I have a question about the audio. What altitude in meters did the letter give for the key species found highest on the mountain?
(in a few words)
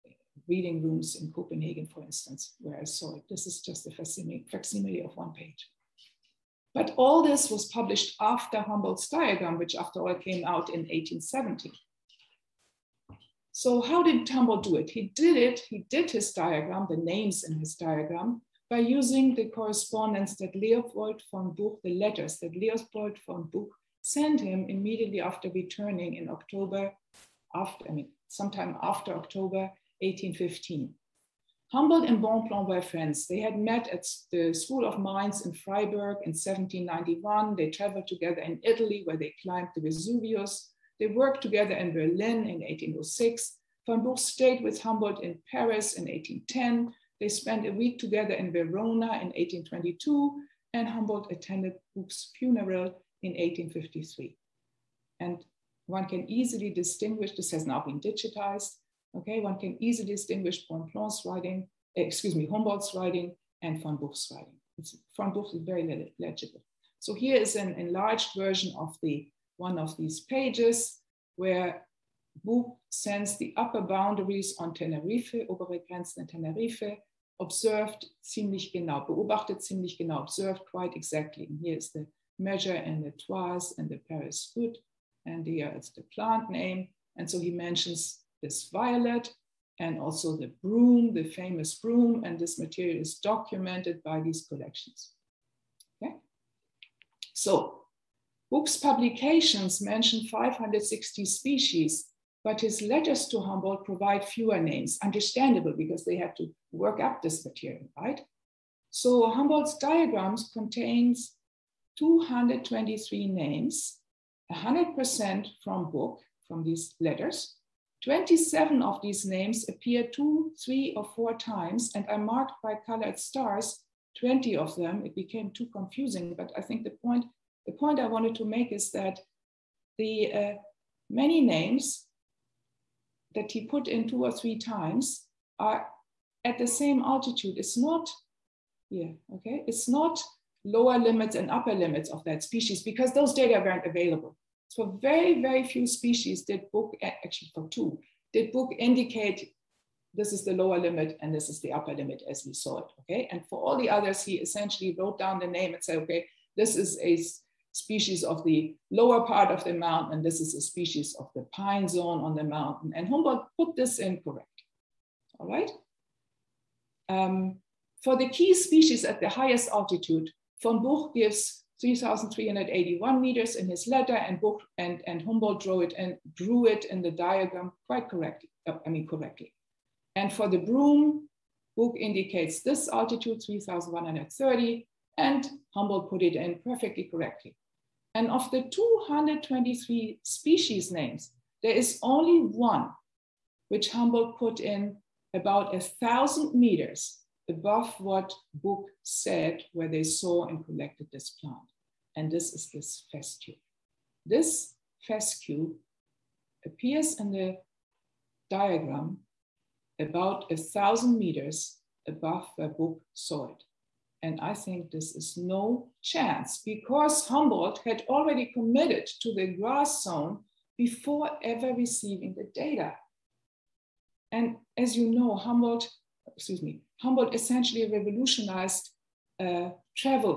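3,381.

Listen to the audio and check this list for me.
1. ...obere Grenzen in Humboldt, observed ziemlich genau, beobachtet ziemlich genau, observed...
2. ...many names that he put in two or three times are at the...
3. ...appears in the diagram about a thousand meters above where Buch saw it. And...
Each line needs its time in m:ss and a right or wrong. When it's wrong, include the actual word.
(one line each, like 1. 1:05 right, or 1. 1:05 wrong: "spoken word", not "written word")
1. 1:15 wrong: "Tenerife", not "Humboldt"
2. 2:11 right
3. 3:26 right.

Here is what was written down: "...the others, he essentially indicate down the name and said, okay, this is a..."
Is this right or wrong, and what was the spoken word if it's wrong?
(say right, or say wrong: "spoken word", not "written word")
wrong: "wrote", not "indicate".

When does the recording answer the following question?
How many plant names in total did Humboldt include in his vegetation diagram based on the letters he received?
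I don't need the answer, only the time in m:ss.
1:51.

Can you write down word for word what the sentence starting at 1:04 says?
It's, von Buch is very legible.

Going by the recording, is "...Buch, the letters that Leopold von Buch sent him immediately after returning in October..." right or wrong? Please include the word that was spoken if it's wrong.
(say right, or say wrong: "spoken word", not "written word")
right.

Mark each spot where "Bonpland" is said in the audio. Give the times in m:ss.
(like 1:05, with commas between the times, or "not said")
0:32, 1:00.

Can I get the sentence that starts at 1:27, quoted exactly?
And so he mentions is violet and also the broom, the famous broom, and this material is documented by these collections.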